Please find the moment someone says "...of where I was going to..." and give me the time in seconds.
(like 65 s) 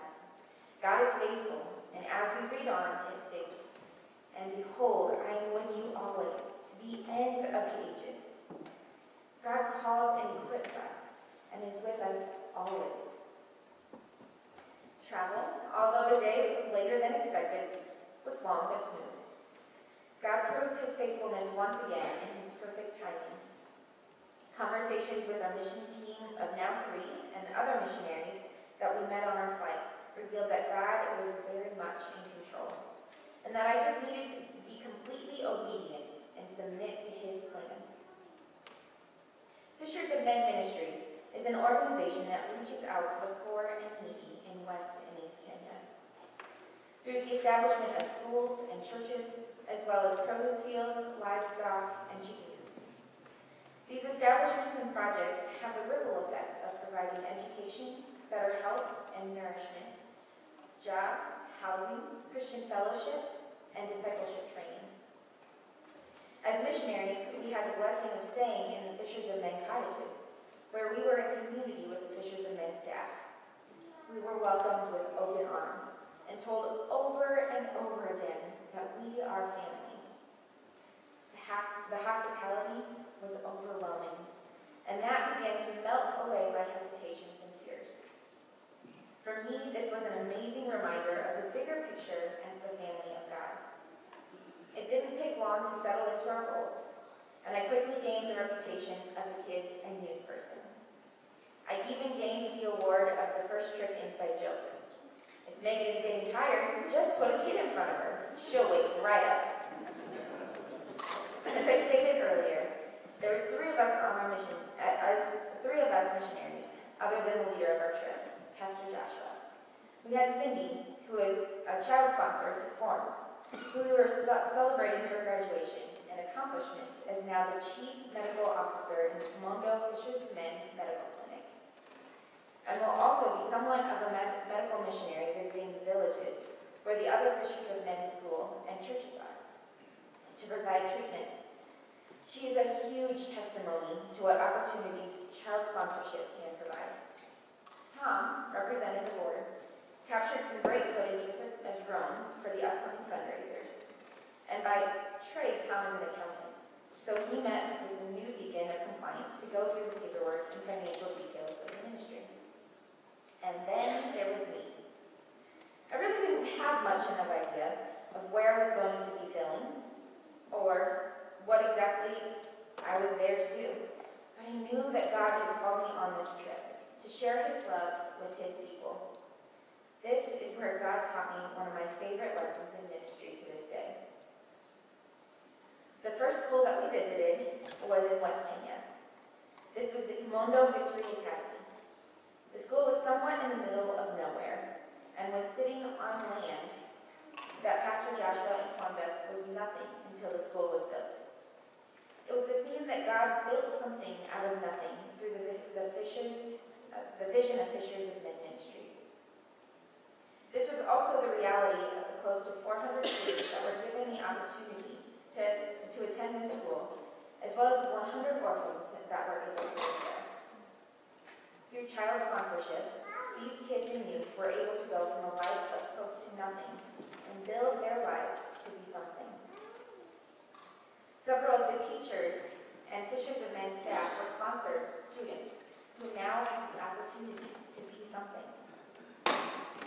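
168 s.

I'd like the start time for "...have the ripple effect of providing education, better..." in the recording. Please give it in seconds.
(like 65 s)
55 s.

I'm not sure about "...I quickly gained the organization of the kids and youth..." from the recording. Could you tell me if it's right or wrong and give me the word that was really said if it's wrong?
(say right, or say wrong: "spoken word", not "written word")
wrong: "reputation", not "organization".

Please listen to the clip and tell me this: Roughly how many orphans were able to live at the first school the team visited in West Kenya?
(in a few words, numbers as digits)
100.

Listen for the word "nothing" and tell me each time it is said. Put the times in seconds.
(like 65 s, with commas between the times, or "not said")
199 s, 204 s, 226 s.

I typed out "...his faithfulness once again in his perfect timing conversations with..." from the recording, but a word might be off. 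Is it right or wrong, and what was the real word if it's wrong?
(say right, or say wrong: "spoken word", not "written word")
right.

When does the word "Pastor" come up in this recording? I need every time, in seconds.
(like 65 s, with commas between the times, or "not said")
118 s, 197 s.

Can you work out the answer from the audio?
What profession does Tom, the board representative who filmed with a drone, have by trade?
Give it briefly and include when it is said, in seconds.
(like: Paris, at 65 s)
accountant, at 156 s.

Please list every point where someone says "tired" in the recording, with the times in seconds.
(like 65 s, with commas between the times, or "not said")
106 s.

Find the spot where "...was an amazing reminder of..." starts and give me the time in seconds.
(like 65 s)
89 s.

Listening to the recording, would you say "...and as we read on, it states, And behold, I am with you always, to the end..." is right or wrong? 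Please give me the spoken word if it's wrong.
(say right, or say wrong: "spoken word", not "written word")
right.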